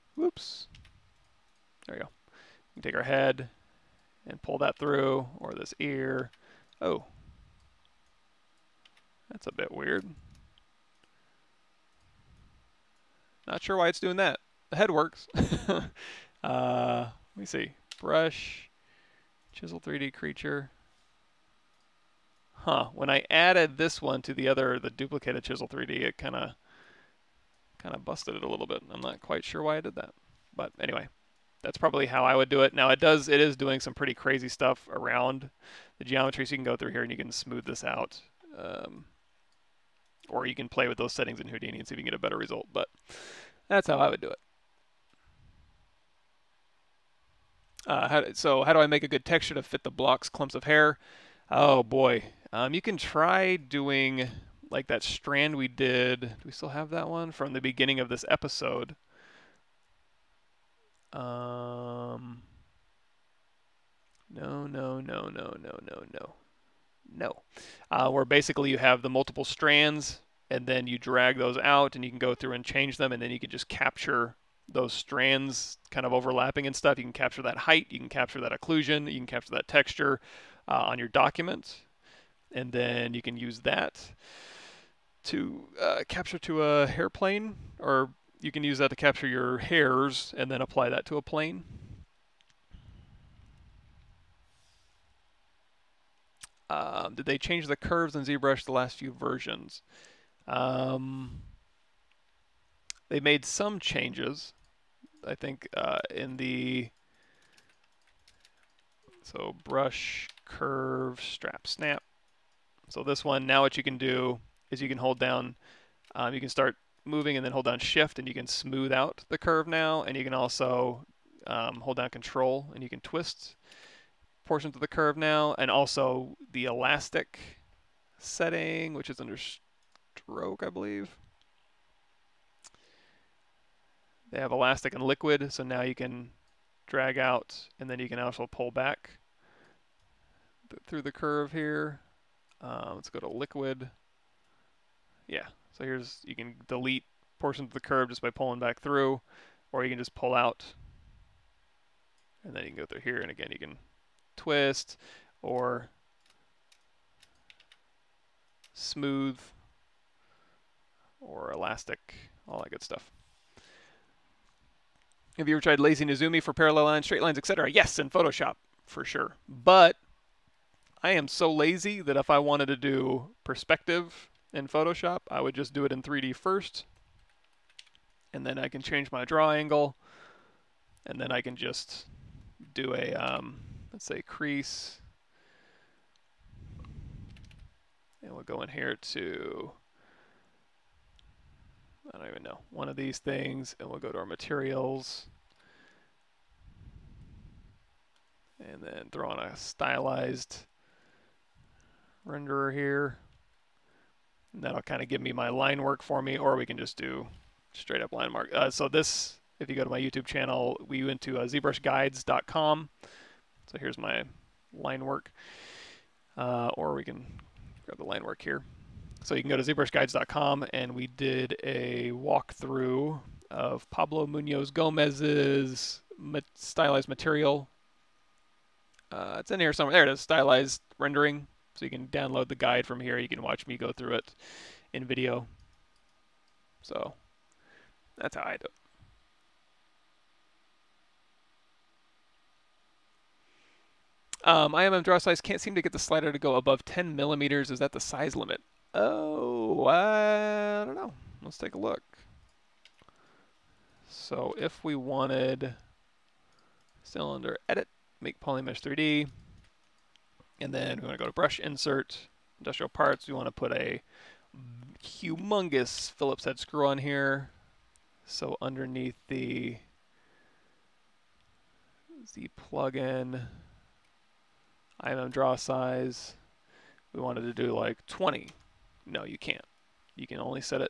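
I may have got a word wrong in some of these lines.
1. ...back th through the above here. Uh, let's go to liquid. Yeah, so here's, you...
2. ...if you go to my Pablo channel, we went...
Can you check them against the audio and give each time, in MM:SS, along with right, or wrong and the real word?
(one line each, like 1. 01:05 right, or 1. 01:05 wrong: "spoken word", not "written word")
1. 02:18 wrong: "curve", not "above"
2. 03:29 wrong: "YouTube", not "Pablo".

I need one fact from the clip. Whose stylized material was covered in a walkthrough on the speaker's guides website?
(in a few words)
Pablo Munoz Gomez.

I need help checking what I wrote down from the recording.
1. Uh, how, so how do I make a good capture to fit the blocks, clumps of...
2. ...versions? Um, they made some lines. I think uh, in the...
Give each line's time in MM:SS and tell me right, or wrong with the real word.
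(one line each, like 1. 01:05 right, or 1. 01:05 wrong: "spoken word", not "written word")
1. 00:47 wrong: "texture", not "capture"
2. 01:39 wrong: "changes", not "lines".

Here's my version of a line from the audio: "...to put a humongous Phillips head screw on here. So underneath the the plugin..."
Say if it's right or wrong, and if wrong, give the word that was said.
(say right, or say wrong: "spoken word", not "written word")
right.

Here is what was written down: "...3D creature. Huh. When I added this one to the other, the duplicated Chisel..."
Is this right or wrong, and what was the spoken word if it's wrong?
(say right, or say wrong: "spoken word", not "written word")
right.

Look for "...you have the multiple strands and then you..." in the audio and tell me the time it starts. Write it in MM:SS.
01:08.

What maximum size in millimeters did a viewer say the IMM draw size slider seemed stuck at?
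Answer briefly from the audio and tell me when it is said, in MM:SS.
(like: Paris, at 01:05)
10 millimeters, at 04:06.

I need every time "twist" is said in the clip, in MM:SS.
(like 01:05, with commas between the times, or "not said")
02:03, 02:34.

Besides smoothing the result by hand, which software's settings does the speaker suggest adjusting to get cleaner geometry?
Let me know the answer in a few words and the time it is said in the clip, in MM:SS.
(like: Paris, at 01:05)
Houdini, at 00:41.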